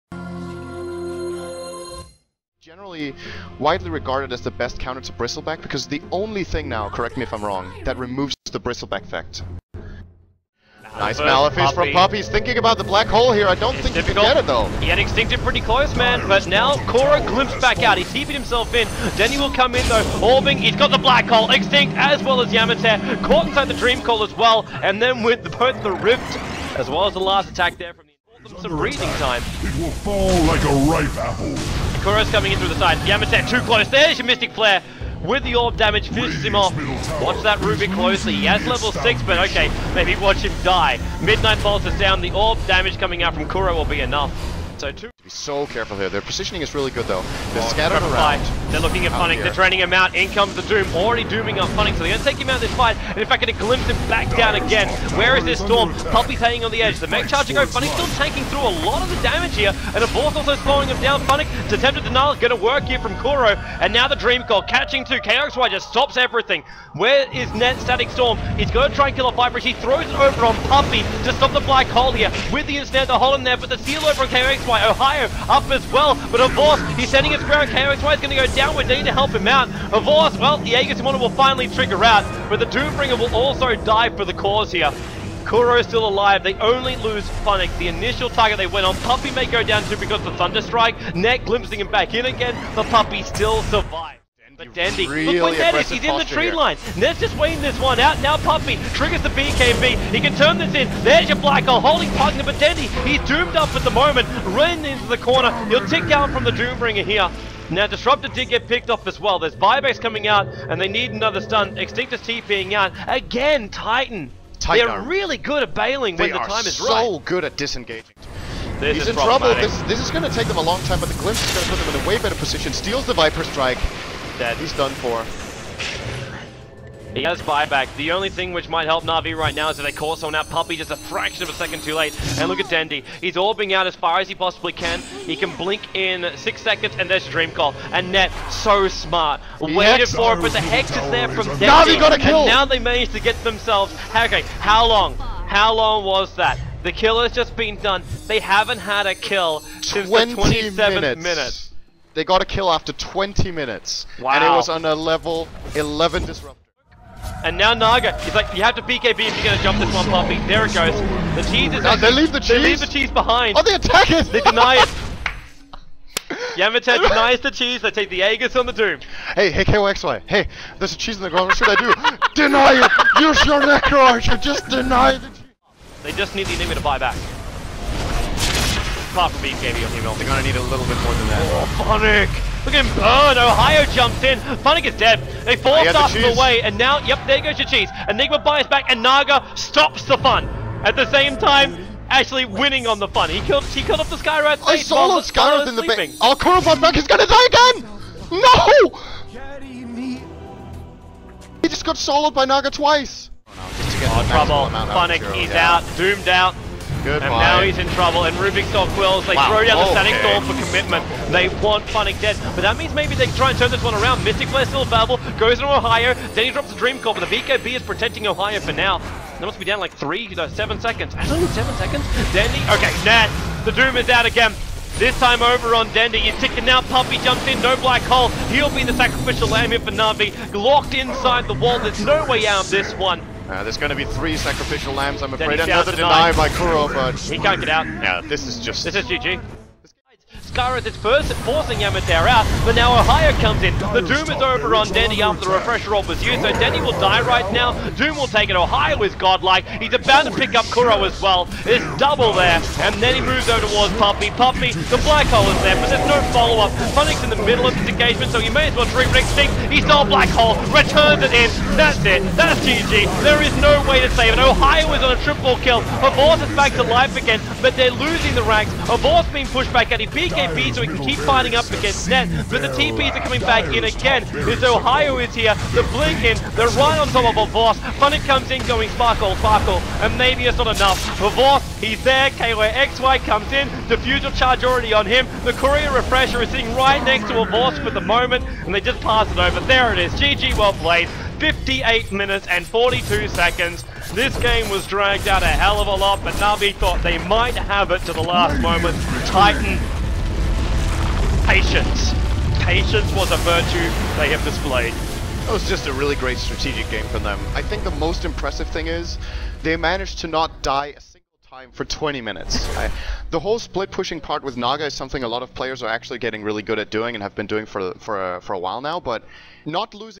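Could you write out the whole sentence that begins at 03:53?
Uh, there's going to be three sacrificial lambs, I'm afraid.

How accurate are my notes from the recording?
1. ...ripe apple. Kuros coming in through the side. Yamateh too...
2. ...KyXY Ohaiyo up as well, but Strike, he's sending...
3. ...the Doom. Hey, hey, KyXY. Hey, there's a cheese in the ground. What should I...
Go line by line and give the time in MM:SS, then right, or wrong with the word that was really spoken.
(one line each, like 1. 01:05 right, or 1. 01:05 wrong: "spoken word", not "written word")
1. 00:30 right
2. 01:14 wrong: "Avos", not "Strike"
3. 02:48 right.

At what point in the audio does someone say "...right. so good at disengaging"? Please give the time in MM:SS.
01:56.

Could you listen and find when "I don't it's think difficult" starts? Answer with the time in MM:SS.
00:13.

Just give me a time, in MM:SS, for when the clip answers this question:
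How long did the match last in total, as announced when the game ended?
04:51.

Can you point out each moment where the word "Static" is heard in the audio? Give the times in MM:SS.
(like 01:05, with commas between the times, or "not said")
01:07, 03:30.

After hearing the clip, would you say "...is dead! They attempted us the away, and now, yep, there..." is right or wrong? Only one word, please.
wrong.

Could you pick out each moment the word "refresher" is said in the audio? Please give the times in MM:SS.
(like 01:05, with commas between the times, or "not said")
04:05, 04:45.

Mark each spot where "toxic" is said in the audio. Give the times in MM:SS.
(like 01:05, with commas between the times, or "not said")
not said.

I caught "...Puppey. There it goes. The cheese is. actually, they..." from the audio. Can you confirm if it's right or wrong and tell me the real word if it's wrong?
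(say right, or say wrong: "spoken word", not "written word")
right.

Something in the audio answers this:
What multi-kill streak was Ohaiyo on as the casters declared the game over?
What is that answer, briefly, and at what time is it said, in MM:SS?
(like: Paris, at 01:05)
triple kill, at 04:25.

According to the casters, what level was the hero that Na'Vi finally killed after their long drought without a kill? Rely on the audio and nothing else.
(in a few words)
11.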